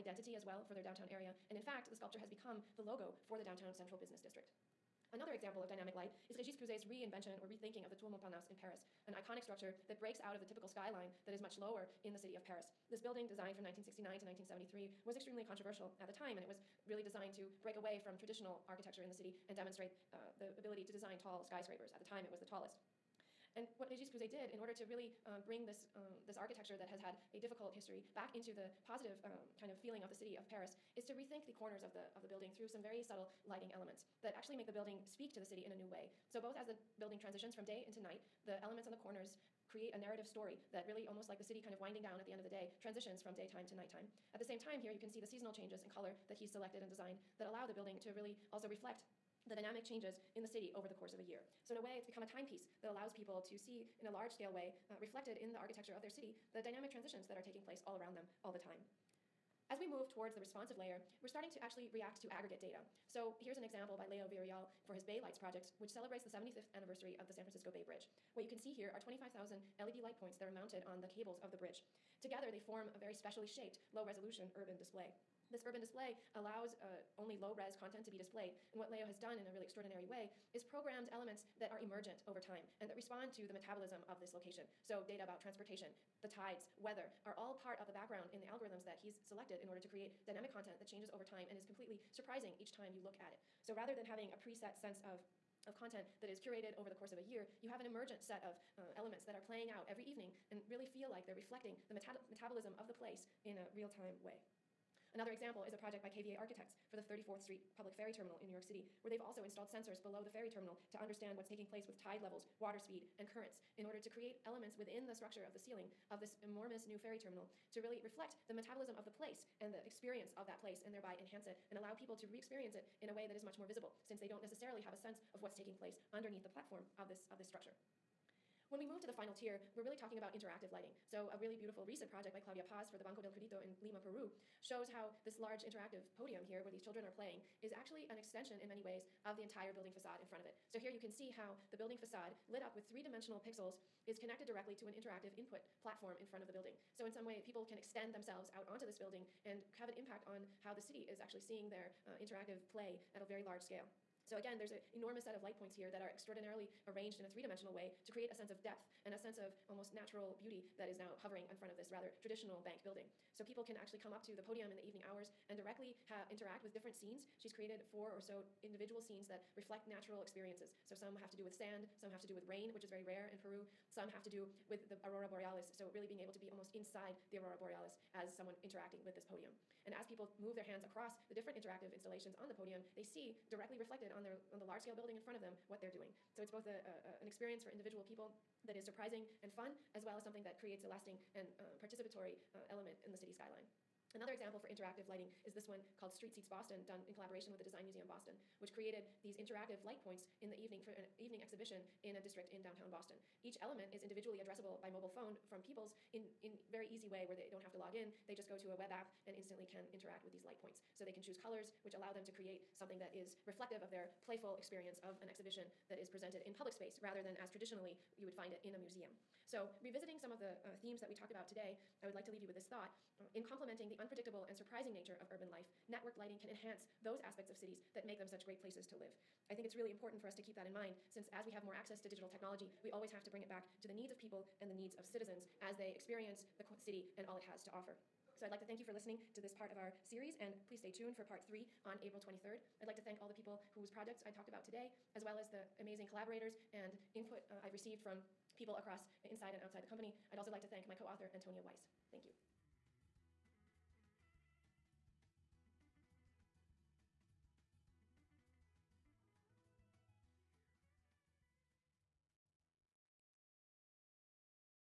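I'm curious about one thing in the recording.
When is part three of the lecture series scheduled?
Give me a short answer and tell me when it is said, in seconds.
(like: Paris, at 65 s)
April 23rd, at 242 s.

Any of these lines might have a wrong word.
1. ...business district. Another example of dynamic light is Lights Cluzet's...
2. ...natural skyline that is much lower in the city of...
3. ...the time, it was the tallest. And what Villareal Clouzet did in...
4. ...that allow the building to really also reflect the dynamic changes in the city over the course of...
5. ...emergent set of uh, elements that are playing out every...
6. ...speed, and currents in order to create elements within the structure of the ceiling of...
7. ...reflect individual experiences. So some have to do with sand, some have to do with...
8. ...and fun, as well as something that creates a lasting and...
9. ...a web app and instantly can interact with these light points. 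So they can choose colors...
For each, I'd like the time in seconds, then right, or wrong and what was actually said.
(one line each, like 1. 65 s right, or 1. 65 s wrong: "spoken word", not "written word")
1. 3 s wrong: "Régis", not "Lights"
2. 10 s wrong: "typical", not "natural"
3. 21 s wrong: "Régis", not "Villareal"
4. 47 s right
5. 97 s right
6. 112 s right
7. 169 s wrong: "natural", not "individual"
8. 189 s right
9. 208 s right.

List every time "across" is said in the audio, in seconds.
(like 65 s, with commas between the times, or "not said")
180 s, 248 s.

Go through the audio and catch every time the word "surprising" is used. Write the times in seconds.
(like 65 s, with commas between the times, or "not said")
92 s, 188 s, 224 s.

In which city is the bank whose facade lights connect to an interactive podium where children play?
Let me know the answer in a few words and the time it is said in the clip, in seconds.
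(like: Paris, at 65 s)
Lima, at 133 s.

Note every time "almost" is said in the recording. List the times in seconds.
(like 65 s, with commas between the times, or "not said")
41 s, 159 s, 176 s.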